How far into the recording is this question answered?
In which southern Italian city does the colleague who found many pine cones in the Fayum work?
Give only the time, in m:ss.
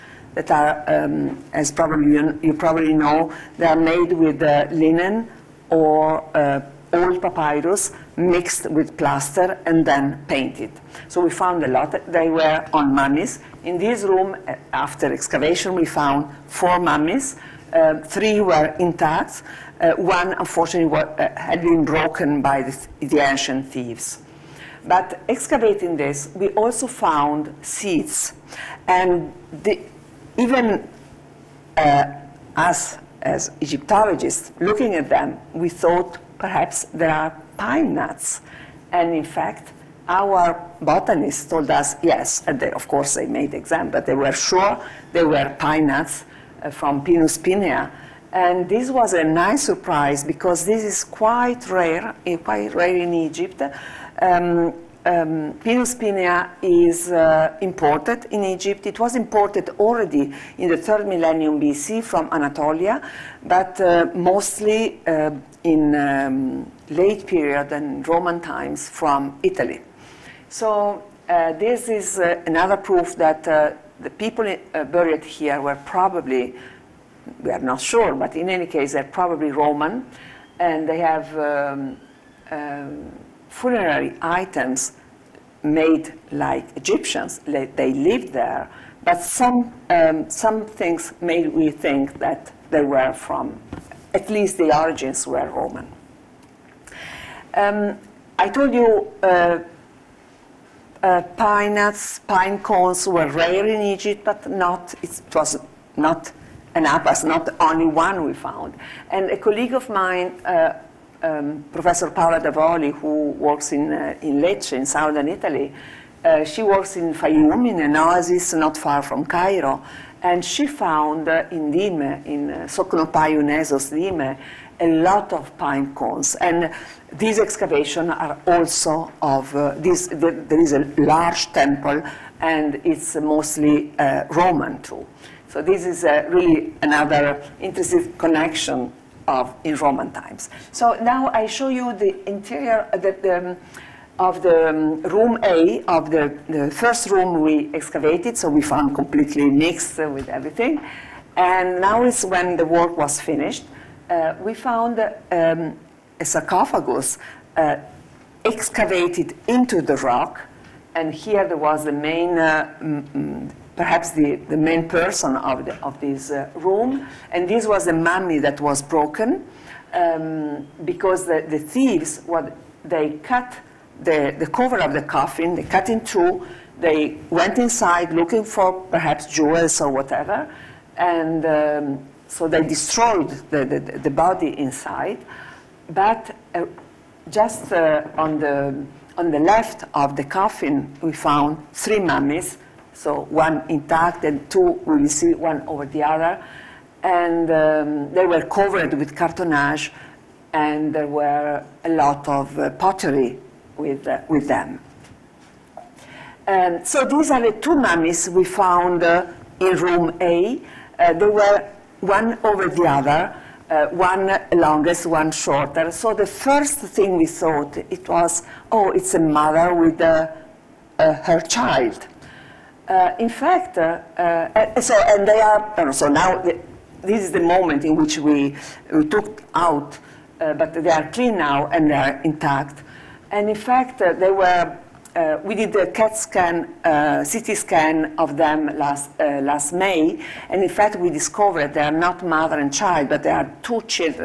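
1:54.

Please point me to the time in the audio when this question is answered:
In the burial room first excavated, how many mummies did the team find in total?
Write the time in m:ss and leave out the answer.
0:16.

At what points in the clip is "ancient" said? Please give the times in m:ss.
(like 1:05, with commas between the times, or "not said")
0:23.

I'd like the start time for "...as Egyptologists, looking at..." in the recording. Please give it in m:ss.
0:33.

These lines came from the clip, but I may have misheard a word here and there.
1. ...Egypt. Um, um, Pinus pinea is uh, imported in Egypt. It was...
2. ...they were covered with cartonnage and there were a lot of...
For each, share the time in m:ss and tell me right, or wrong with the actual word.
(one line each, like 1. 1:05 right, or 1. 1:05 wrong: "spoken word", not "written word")
1. 0:53 right
2. 3:18 right.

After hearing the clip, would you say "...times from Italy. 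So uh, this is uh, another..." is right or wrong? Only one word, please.
right.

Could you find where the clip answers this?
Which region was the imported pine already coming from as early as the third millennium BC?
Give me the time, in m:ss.
1:02.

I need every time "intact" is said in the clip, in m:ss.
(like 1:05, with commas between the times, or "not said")
0:18, 3:13, 3:52.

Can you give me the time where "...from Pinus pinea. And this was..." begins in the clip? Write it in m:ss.
0:46.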